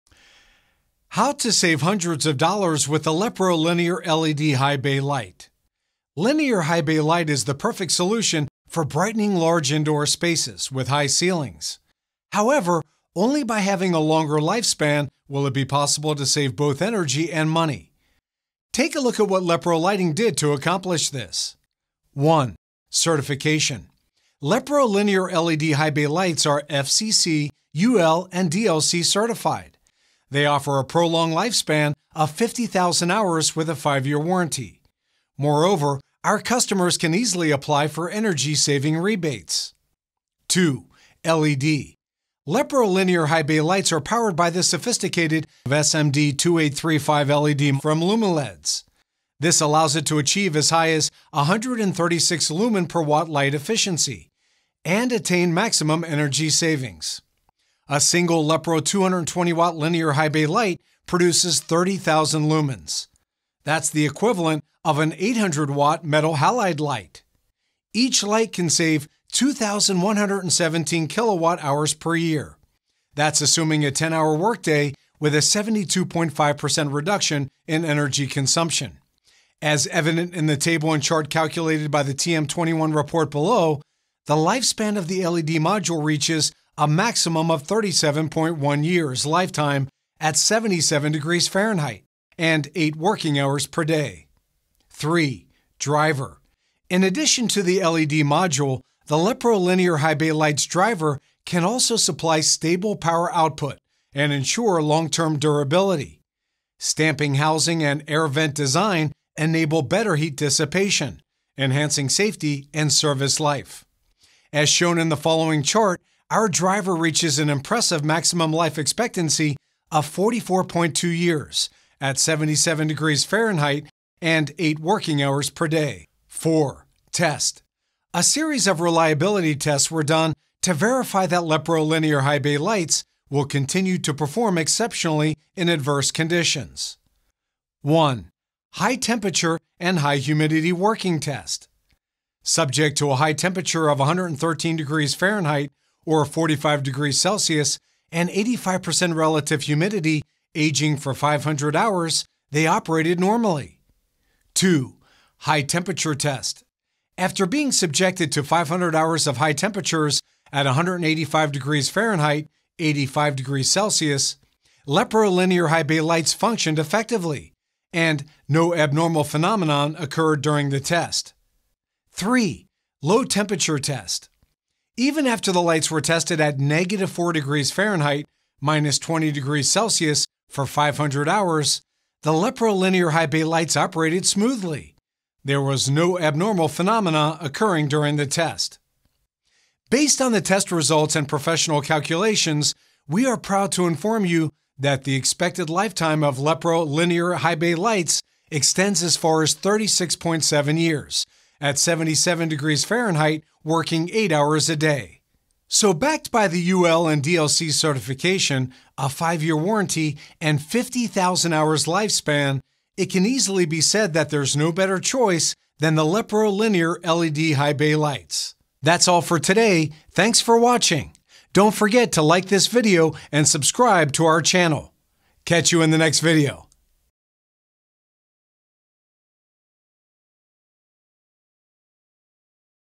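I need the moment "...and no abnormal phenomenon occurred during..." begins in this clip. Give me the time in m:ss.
2:47.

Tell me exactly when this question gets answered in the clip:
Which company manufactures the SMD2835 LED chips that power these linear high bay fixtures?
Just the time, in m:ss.
0:48.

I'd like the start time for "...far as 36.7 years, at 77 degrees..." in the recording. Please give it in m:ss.
3:19.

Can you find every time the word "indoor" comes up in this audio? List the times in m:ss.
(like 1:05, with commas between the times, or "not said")
0:09.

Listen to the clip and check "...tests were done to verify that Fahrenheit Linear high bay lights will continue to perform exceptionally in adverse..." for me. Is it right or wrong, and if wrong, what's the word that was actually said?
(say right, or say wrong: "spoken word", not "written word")
wrong: "Lepro", not "Fahrenheit".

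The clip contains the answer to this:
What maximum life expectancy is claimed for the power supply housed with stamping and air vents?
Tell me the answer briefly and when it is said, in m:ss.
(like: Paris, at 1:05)
44.2 years, at 2:00.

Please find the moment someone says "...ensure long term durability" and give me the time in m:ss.
1:44.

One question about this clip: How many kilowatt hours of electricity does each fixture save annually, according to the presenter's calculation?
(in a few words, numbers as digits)
2,117.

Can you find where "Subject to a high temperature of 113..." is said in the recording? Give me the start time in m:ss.
2:22.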